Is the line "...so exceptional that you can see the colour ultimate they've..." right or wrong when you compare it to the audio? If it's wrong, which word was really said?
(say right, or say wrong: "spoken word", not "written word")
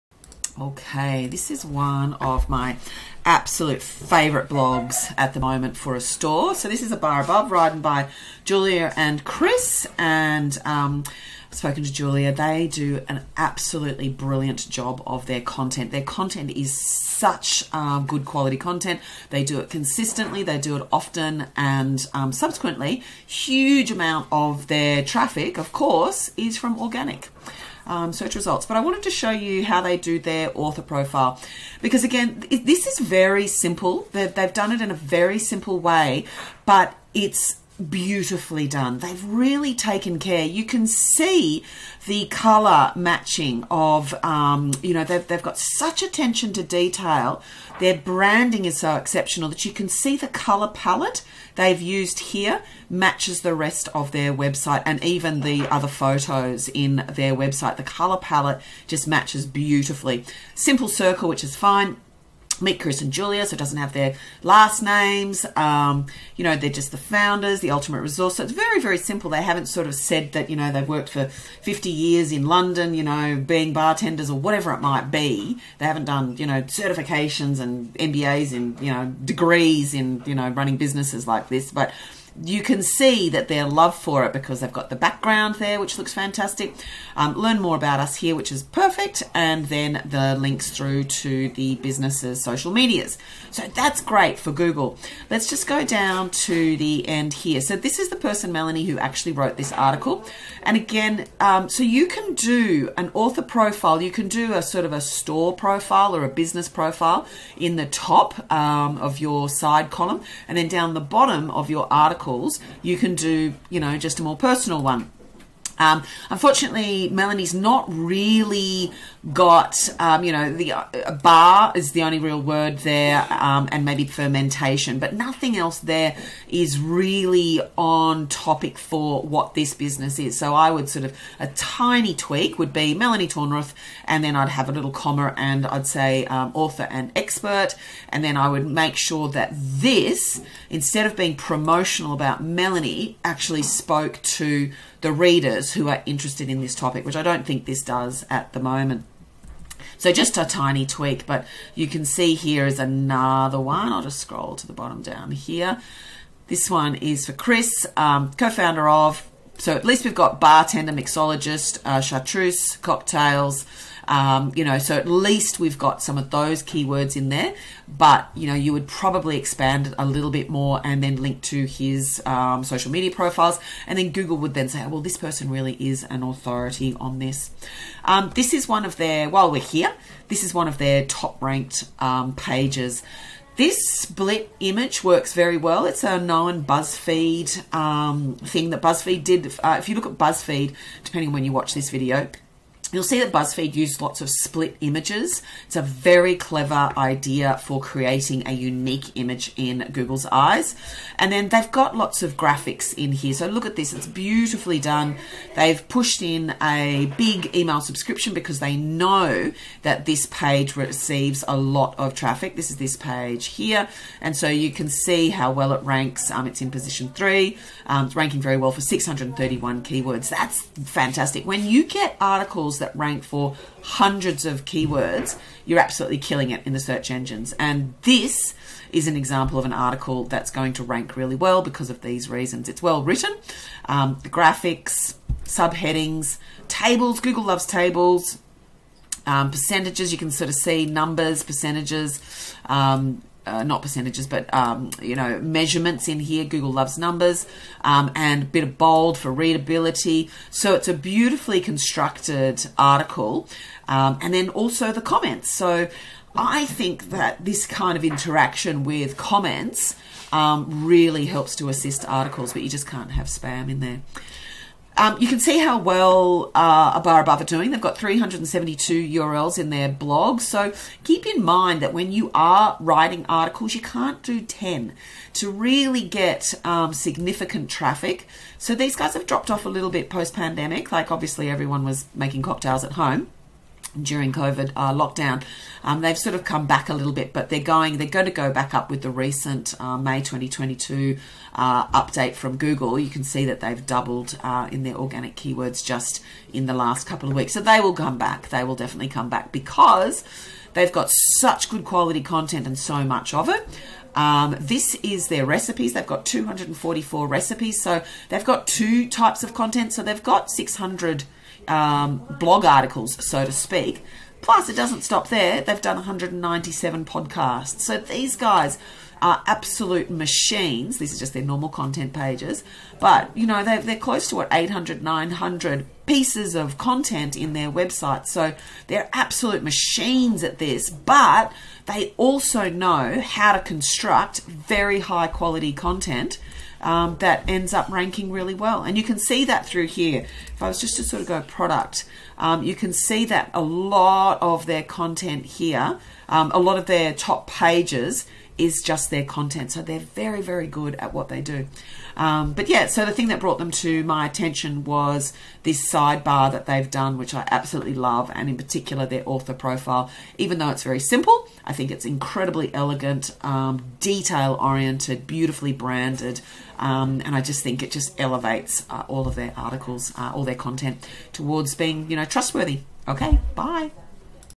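wrong: "palette", not "ultimate".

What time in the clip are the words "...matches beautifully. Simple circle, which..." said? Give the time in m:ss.
0:59.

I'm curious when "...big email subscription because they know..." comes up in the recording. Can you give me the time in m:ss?
3:27.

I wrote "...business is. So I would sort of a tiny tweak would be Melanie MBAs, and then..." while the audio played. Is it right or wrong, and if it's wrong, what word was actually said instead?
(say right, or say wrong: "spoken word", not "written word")
wrong: "Tornruth", not "MBAs".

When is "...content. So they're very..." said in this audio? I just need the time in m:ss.
5:49.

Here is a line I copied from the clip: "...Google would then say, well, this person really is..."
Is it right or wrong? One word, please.
right.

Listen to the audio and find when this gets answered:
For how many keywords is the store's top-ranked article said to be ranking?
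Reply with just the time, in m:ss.
3:38.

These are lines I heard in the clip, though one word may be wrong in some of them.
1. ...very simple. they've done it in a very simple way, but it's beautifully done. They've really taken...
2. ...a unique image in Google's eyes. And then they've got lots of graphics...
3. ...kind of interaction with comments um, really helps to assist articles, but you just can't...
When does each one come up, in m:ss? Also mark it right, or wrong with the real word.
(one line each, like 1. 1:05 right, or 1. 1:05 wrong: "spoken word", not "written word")
1. 0:32 right
2. 3:18 right
3. 4:17 right.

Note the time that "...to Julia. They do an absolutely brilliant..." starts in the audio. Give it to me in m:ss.
0:11.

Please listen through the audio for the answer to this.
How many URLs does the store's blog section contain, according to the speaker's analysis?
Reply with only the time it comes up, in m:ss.
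4:27.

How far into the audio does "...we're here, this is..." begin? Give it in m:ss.
2:59.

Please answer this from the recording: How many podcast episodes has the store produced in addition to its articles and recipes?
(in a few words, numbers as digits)
197.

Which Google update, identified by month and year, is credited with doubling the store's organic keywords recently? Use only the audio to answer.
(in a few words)
May 2022.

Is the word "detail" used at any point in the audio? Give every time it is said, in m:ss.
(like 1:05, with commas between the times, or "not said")
0:46, 6:03.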